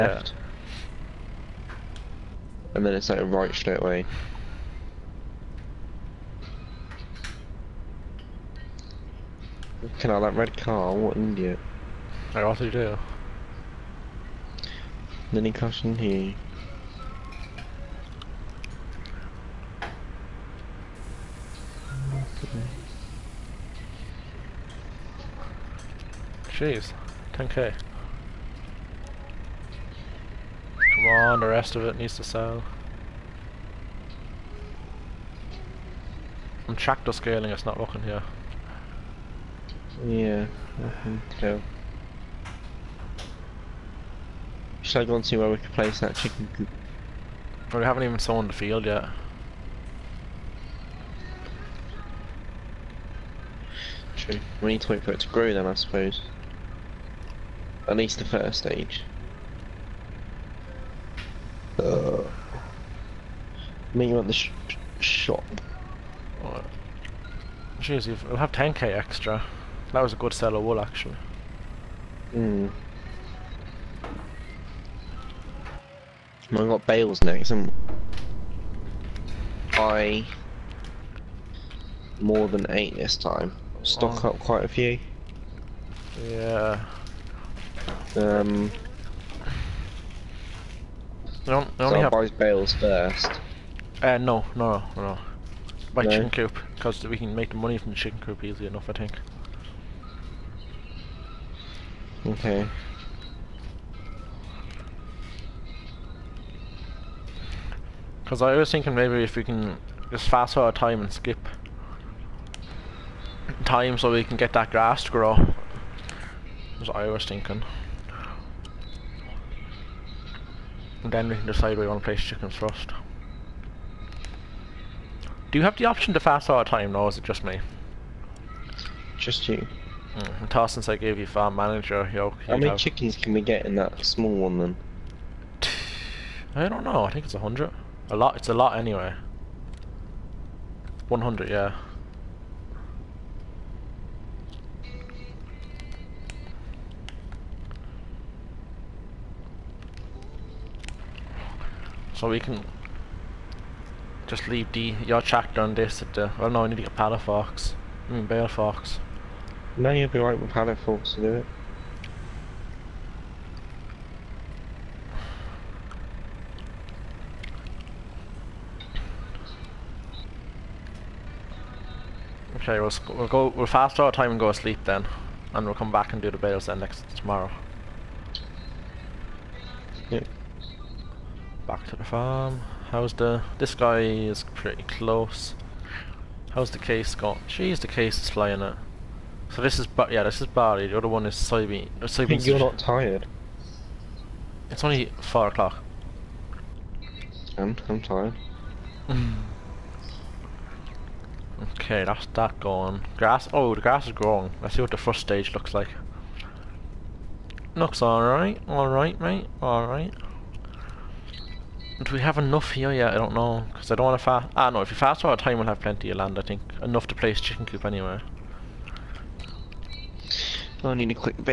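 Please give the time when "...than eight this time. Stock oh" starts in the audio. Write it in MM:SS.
01:22.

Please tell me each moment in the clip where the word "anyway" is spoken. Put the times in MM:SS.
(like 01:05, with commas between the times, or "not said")
02:18, 03:37.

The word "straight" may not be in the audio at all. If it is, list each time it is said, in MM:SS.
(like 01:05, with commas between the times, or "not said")
00:03.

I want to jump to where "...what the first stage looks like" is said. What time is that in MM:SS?
03:24.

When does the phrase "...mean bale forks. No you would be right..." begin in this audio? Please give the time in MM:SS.
02:38.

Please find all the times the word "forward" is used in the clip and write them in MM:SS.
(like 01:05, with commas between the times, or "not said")
01:50, 03:35.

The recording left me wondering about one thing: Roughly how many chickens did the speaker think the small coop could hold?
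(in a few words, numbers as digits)
100.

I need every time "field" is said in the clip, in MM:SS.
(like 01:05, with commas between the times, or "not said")
00:48.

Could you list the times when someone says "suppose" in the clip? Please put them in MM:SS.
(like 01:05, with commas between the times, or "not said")
00:55.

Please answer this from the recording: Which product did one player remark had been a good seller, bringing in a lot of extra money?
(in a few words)
Wool.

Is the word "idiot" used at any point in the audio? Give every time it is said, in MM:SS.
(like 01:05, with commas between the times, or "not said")
00:11.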